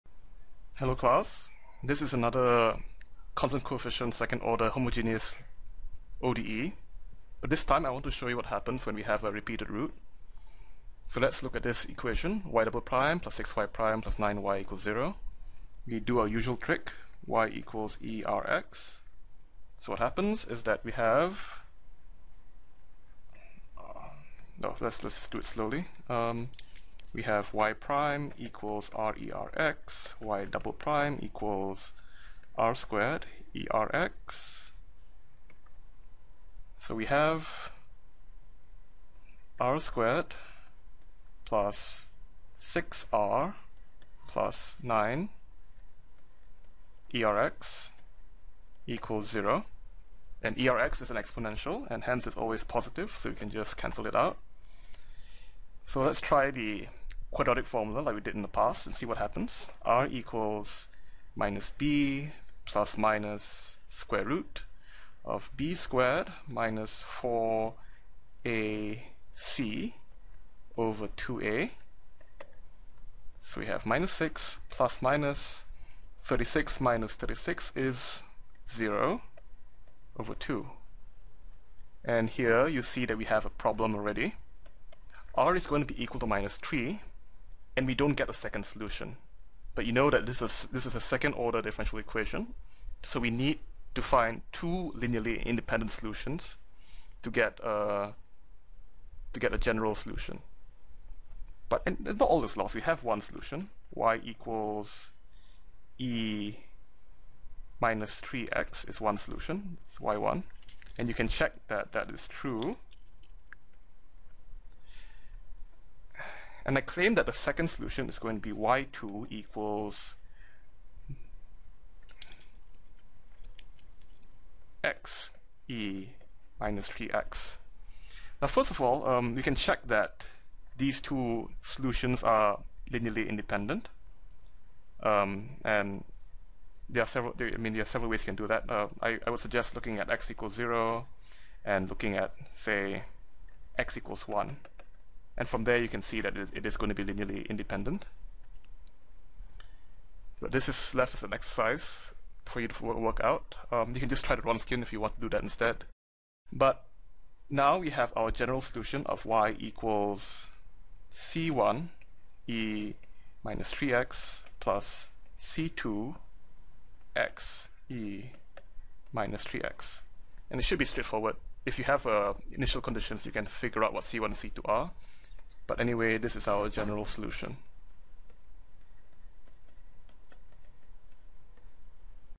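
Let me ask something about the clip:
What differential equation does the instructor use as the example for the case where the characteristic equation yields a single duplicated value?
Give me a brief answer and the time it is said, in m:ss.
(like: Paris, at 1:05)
y'' + 6y' + 9y = 0, at 0:12.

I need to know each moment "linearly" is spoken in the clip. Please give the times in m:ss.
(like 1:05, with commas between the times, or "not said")
1:34, 2:12, 2:27.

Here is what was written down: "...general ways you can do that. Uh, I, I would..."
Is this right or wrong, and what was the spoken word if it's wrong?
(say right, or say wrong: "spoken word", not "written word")
wrong: "several", not "general".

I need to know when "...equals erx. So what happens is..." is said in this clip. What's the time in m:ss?
0:17.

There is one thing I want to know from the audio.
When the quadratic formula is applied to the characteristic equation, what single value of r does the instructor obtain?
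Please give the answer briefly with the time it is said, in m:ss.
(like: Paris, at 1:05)
-3, at 1:26.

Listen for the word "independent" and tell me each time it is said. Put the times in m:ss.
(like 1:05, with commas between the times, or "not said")
1:35, 2:13, 2:27.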